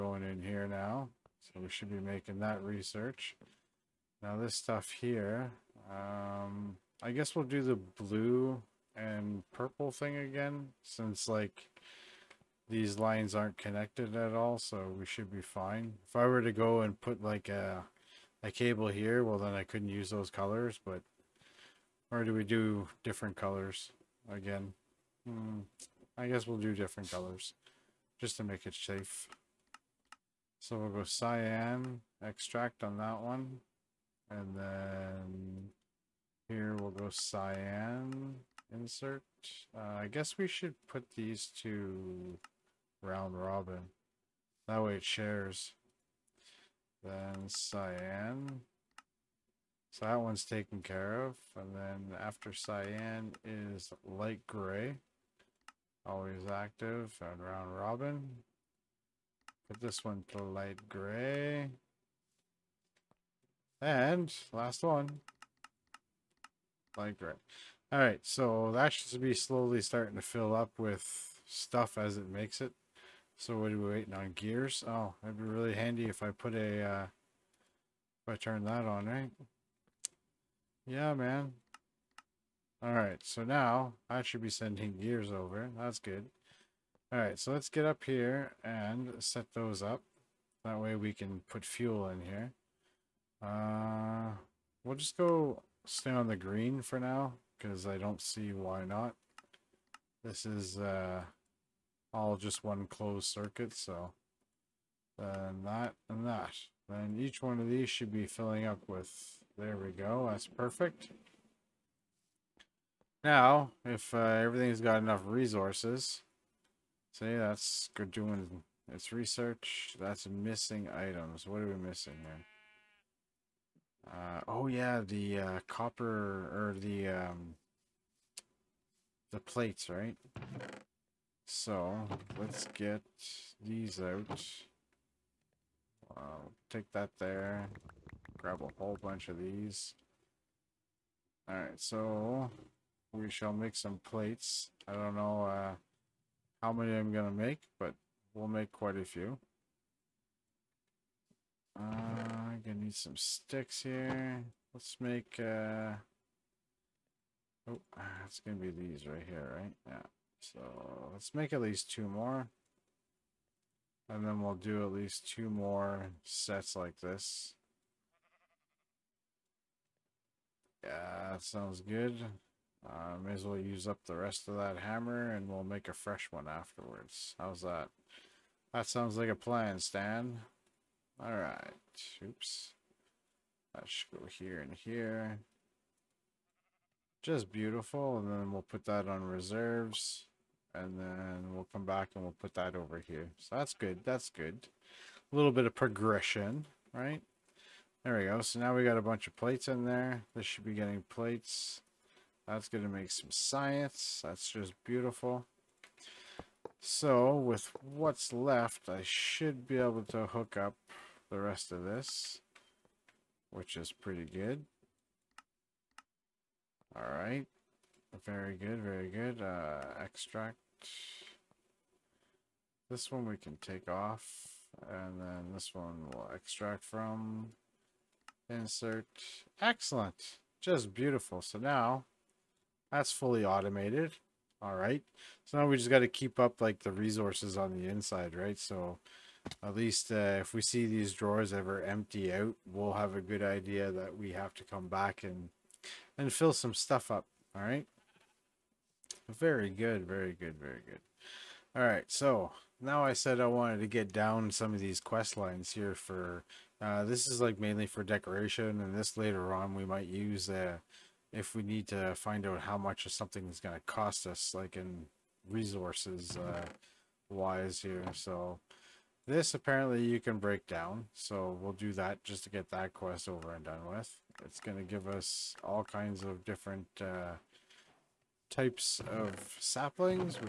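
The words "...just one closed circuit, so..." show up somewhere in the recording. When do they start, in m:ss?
1:42.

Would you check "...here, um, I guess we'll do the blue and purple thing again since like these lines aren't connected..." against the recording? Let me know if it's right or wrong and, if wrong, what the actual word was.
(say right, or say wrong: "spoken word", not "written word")
right.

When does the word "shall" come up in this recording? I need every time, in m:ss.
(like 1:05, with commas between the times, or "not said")
2:23.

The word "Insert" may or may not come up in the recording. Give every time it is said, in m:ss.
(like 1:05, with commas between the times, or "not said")
0:38, 3:48.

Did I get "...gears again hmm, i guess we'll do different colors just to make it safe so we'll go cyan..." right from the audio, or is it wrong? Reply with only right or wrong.
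wrong.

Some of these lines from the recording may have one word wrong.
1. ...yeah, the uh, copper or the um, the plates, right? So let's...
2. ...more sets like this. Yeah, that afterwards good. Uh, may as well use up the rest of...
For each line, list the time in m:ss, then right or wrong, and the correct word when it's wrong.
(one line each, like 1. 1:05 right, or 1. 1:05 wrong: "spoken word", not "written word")
1. 2:04 right
2. 2:45 wrong: "sounds", not "afterwards".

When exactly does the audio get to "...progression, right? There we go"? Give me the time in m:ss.
3:15.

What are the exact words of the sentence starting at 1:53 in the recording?
Now, if uh, everything's got enough resources, see that's good doing its research, that's missing items.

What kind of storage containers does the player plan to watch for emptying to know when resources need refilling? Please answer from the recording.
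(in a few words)
Drawers.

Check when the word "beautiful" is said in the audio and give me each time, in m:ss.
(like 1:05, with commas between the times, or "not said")
3:07, 3:24, 3:50.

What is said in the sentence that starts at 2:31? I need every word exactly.
Uh, I'm gonna need some sticks here.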